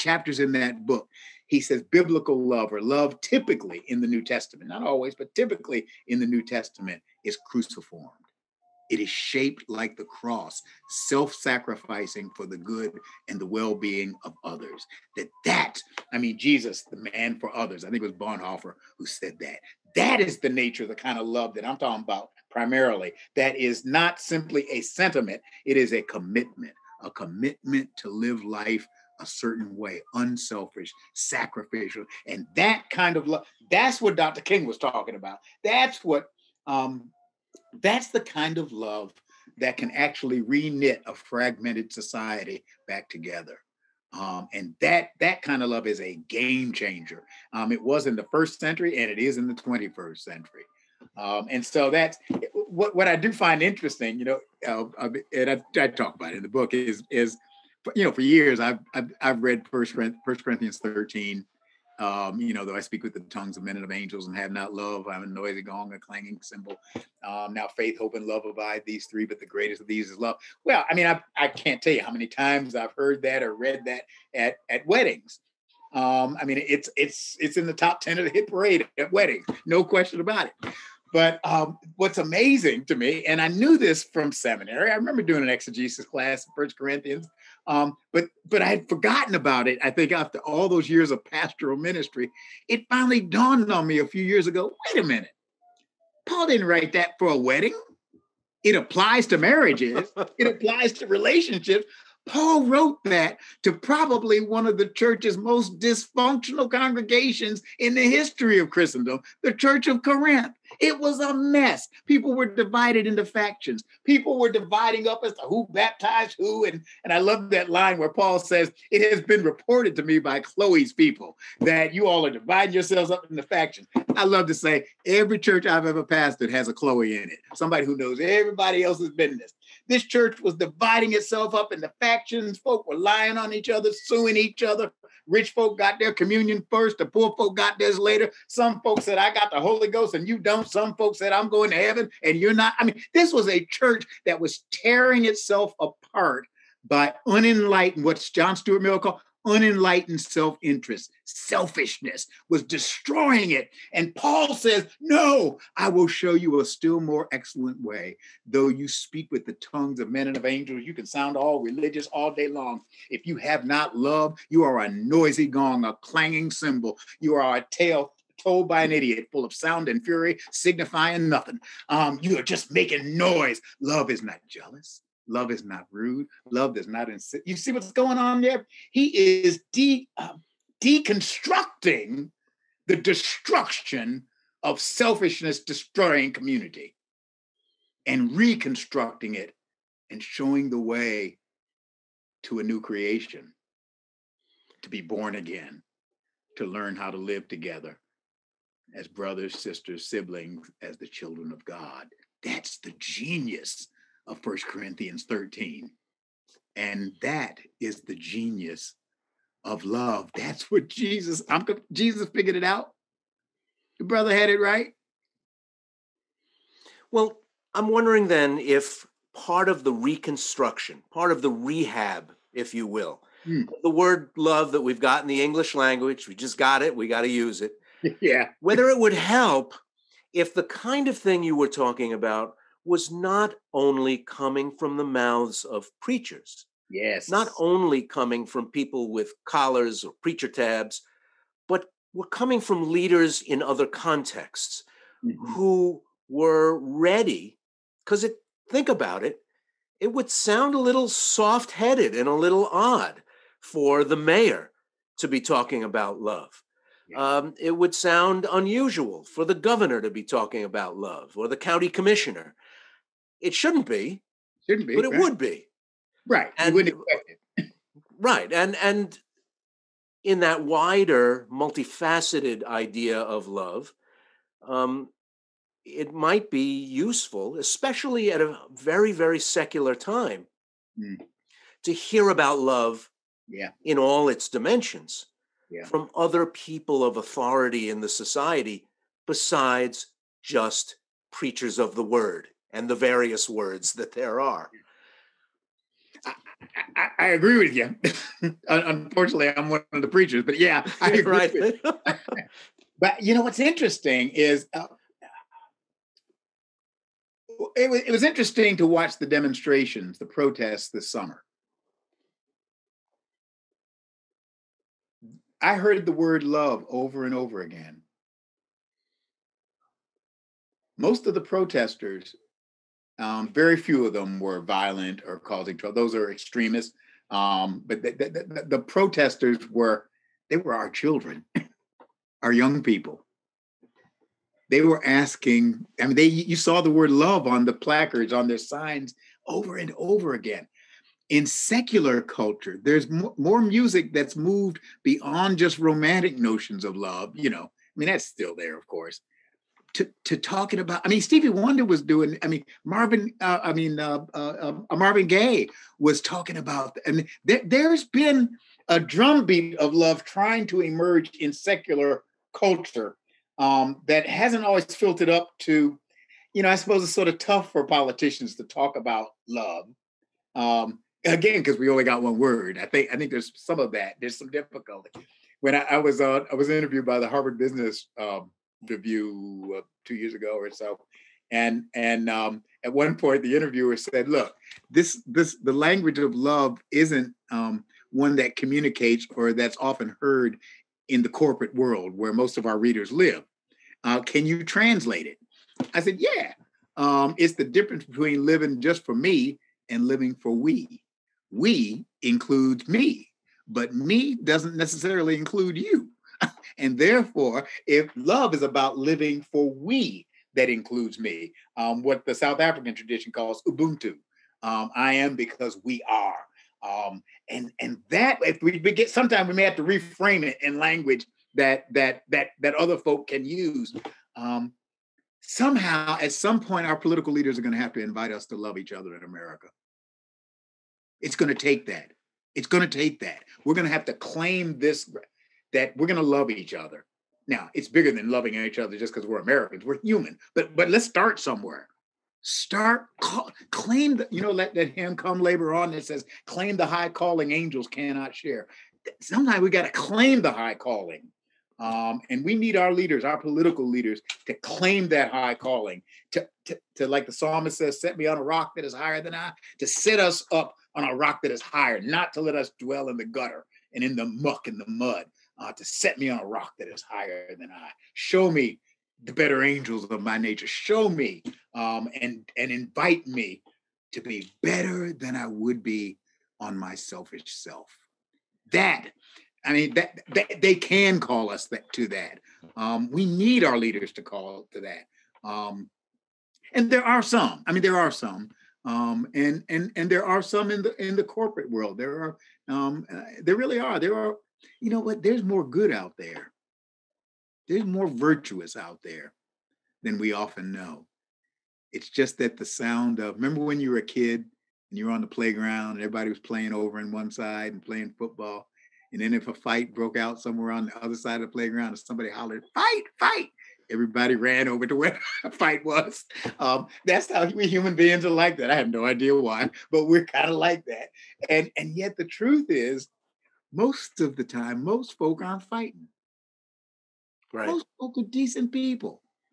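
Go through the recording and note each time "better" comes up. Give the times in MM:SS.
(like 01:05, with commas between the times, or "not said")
07:49, 07:54.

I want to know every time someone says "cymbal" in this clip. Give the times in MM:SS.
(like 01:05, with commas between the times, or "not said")
01:06, 02:46.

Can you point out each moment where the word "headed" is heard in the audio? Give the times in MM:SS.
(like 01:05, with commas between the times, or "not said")
04:11.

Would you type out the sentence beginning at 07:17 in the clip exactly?
Now, it's bigger than loving each other just because we're Americans.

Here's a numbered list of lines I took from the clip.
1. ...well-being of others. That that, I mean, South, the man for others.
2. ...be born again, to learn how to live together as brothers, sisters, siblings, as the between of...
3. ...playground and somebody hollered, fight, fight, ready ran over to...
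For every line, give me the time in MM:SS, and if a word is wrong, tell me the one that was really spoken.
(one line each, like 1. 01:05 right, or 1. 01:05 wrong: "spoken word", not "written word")
1. 00:13 wrong: "Jesus", not "South"
2. 03:14 wrong: "children", not "between"
3. 08:31 wrong: "everybody", not "ready".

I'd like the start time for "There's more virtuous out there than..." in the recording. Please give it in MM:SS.
08:17.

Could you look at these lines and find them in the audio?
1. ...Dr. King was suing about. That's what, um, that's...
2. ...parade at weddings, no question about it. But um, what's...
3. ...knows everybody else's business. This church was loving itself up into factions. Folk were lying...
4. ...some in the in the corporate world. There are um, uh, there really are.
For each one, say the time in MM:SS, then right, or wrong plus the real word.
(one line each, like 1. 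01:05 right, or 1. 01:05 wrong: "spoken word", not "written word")
1. 00:34 wrong: "talking", not "suing"
2. 01:18 right
3. 02:07 wrong: "dividing", not "loving"
4. 08:10 right.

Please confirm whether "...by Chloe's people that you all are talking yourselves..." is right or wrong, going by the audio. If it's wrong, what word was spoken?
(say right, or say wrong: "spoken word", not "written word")
wrong: "dividing", not "talking".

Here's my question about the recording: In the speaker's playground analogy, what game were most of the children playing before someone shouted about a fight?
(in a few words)
football.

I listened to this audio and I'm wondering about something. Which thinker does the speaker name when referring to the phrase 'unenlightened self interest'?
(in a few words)
John Stuart Mill.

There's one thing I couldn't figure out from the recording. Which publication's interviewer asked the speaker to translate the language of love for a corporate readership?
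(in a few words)
Harvard Business.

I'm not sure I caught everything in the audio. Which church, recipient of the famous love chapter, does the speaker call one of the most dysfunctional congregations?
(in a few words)
Church of Corinth.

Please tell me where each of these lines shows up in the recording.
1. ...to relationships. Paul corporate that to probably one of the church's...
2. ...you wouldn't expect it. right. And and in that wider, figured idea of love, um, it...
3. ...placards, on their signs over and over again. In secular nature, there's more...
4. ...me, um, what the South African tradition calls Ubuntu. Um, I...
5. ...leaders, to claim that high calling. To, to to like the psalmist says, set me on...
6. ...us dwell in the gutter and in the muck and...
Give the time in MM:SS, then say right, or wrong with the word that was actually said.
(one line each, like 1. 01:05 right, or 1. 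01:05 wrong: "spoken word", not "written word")
1. 01:40 wrong: "wrote", not "corporate"
2. 04:26 wrong: "multifaceted", not "figured"
3. 05:37 wrong: "culture", not "nature"
4. 06:51 right
5. 07:33 right
6. 07:42 right.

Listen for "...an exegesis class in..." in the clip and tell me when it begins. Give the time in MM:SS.
01:25.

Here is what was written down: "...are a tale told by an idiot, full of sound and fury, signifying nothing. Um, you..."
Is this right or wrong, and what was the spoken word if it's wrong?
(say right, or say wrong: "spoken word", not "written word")
right.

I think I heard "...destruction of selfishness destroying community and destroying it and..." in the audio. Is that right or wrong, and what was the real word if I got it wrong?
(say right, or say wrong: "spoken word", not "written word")
wrong: "reconstructing", not "destroying".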